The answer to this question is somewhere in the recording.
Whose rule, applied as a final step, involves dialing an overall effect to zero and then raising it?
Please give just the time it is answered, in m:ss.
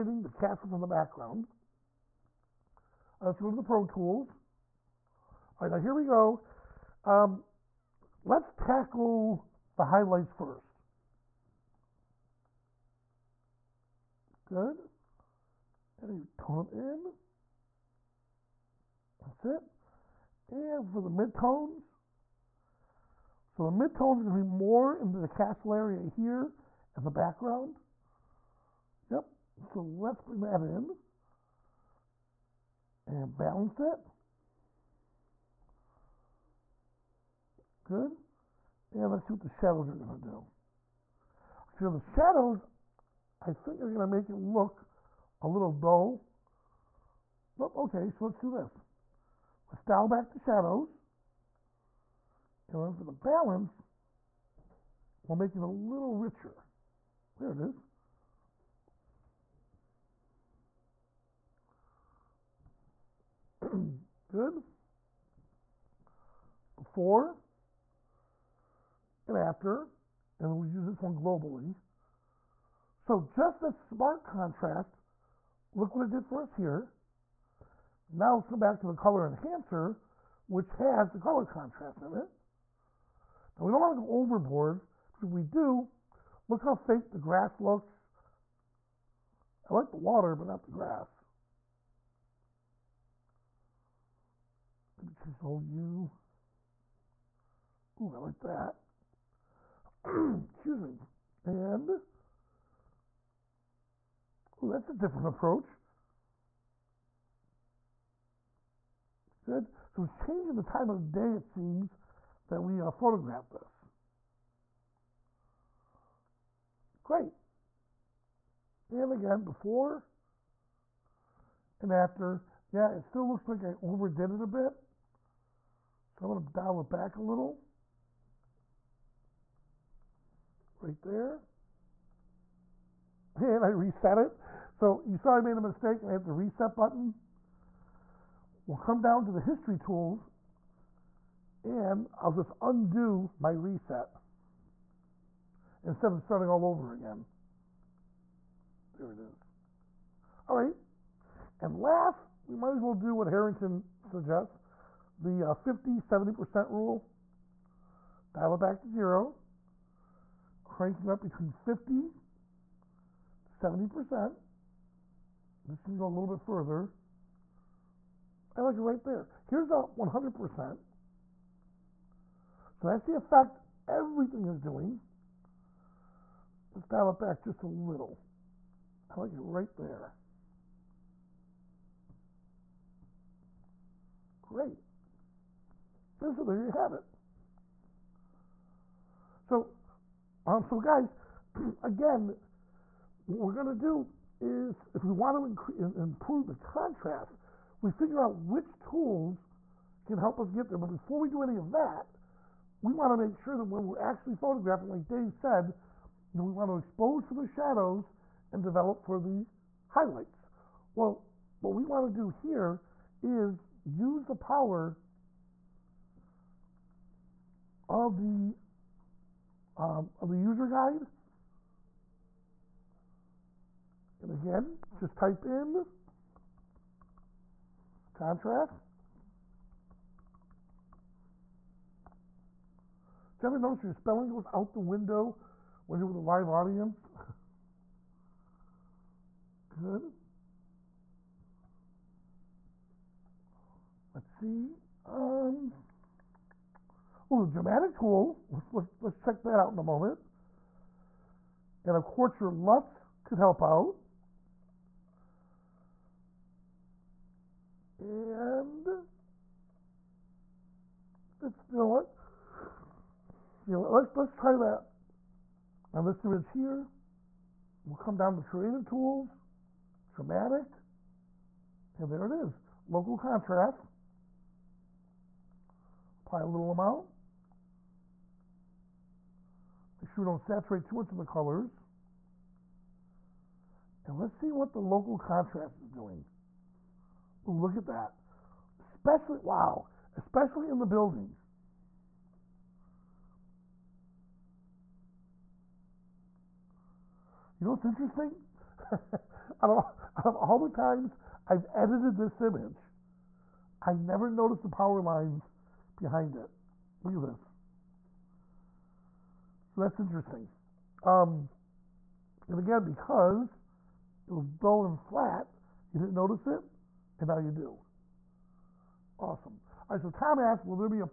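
2:33.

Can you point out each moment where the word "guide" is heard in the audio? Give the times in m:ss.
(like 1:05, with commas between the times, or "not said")
3:40.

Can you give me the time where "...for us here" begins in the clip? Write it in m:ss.
1:16.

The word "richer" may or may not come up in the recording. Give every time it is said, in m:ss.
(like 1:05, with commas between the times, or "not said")
0:56.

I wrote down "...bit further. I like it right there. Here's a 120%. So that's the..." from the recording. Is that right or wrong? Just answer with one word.
wrong.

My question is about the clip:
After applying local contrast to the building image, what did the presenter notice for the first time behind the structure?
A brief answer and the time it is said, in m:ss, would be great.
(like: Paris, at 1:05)
Power lines, at 5:04.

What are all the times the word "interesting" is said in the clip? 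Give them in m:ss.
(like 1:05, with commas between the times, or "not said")
4:57, 5:09.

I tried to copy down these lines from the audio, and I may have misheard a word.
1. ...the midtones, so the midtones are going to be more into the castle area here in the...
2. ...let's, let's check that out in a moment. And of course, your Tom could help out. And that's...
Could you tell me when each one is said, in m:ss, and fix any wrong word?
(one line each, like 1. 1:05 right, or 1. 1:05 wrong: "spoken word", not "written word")
1. 0:21 right
2. 4:08 wrong: "LUTs", not "Tom".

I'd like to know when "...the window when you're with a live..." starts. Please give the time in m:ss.
3:54.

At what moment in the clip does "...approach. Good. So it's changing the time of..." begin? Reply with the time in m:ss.
1:45.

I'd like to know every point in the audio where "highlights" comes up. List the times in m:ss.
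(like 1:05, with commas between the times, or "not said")
0:09, 3:29.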